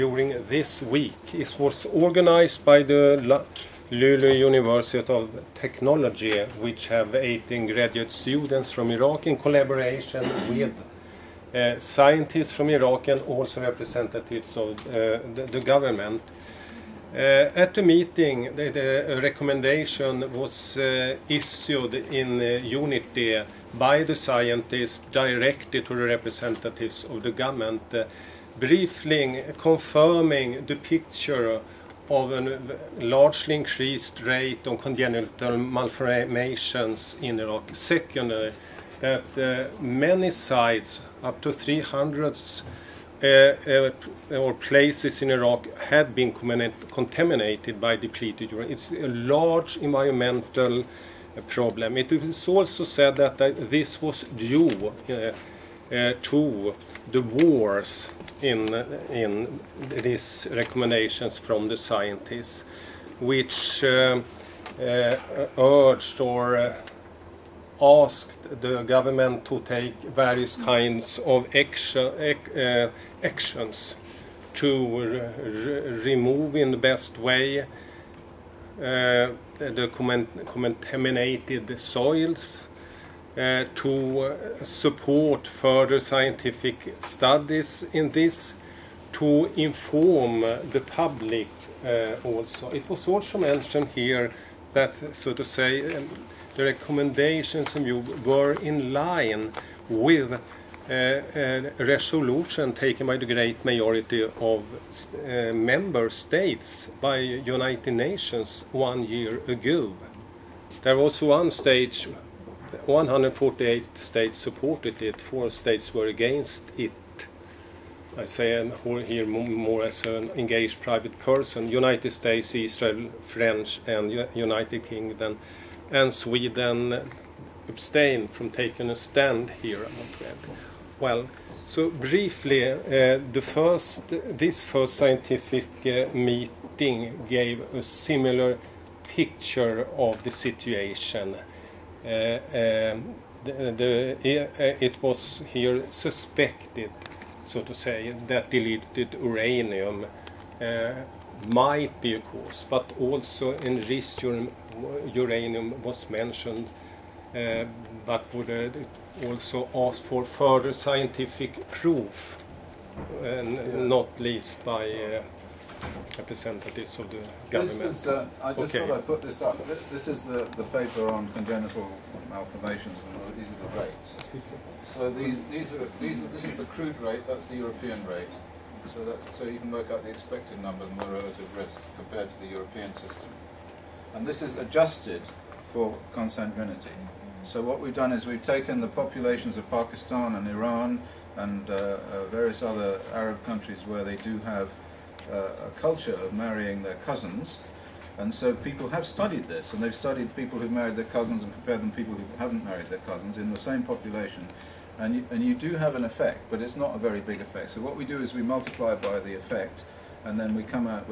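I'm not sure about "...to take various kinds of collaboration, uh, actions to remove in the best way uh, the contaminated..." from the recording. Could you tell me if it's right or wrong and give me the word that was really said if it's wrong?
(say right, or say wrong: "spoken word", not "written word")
wrong: "action", not "collaboration".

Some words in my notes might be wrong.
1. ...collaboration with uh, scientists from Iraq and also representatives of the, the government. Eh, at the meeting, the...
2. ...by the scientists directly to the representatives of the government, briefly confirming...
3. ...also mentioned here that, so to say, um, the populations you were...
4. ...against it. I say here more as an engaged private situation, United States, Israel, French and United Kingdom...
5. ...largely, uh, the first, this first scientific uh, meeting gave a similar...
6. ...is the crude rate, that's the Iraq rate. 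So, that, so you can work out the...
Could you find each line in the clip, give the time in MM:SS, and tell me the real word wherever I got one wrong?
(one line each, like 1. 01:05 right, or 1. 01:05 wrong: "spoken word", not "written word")
1. 00:09 right
2. 00:23 right
3. 01:33 wrong: "recommendations", not "populations"
4. 01:56 wrong: "person", not "situation"
5. 02:11 wrong: "briefly", not "largely"
6. 02:56 wrong: "European", not "Iraq".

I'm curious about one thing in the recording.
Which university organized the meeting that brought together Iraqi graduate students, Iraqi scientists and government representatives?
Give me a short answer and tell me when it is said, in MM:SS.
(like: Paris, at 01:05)
Luleå University of Technology, at 00:03.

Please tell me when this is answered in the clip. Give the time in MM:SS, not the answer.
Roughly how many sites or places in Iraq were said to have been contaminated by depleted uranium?
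00:41.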